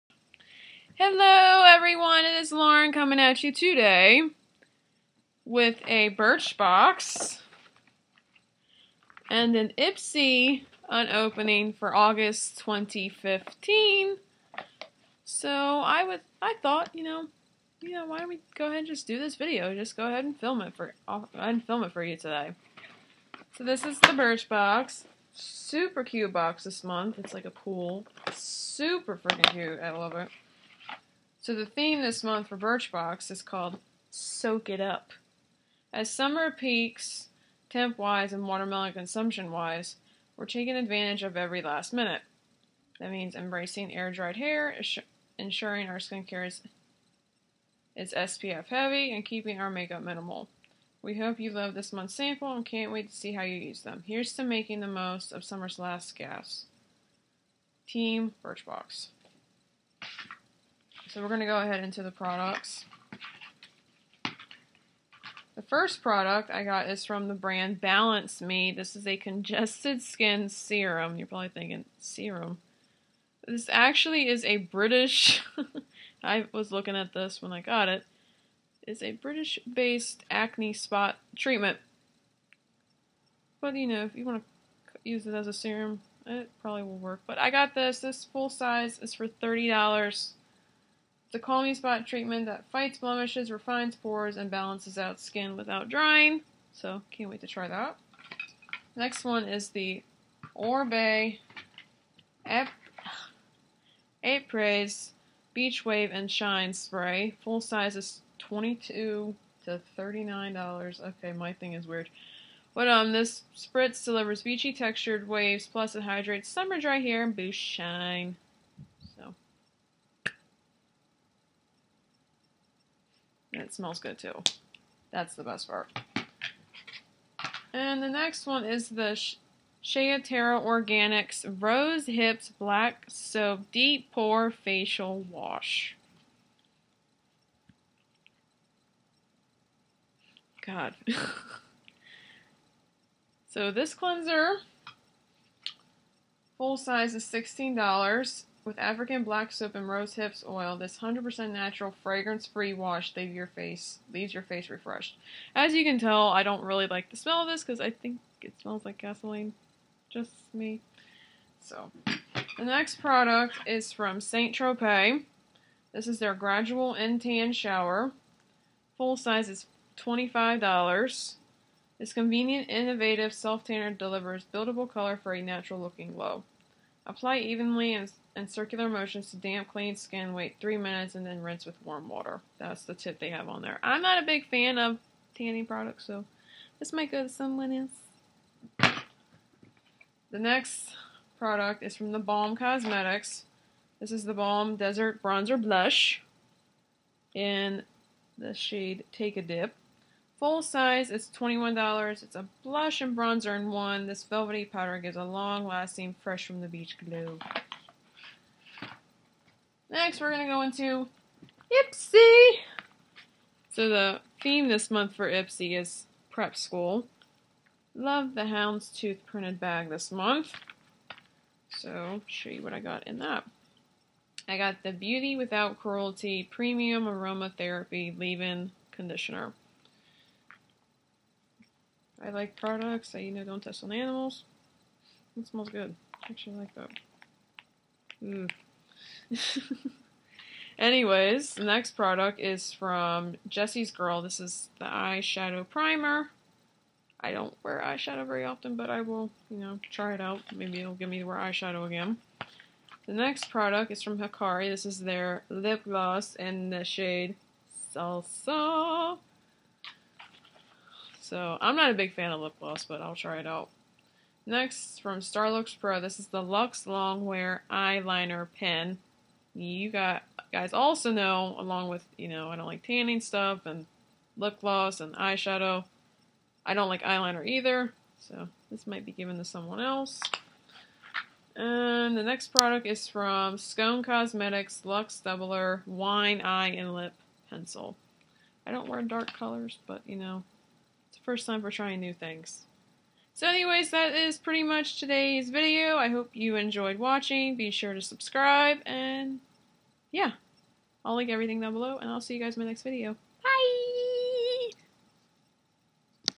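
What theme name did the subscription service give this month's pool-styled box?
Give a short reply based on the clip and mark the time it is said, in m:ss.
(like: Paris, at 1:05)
Soak It Up, at 0:34.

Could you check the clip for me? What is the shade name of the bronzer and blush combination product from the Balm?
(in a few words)
Take a Dip.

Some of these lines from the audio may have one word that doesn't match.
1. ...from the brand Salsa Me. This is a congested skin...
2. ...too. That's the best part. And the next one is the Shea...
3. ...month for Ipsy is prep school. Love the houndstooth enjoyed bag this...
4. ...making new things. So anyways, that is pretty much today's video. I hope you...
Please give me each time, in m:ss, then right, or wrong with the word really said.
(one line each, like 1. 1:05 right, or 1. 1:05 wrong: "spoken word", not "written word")
1. 1:07 wrong: "Balance", not "Salsa"
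2. 2:04 right
3. 3:34 wrong: "printed", not "enjoyed"
4. 4:51 wrong: "trying", not "making".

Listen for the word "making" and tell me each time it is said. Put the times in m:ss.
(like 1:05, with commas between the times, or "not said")
0:54.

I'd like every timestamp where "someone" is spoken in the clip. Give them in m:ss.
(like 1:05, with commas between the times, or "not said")
3:07, 4:39.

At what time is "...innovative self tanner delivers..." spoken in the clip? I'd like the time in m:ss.
2:52.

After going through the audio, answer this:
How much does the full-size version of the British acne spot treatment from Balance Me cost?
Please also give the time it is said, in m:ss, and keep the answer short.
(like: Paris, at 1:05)
$30, at 1:29.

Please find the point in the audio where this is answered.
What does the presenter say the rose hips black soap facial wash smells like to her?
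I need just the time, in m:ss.
2:38.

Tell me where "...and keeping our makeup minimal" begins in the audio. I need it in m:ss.
0:49.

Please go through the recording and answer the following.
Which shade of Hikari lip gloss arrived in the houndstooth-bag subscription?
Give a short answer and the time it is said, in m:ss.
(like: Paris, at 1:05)
Salsa, at 4:17.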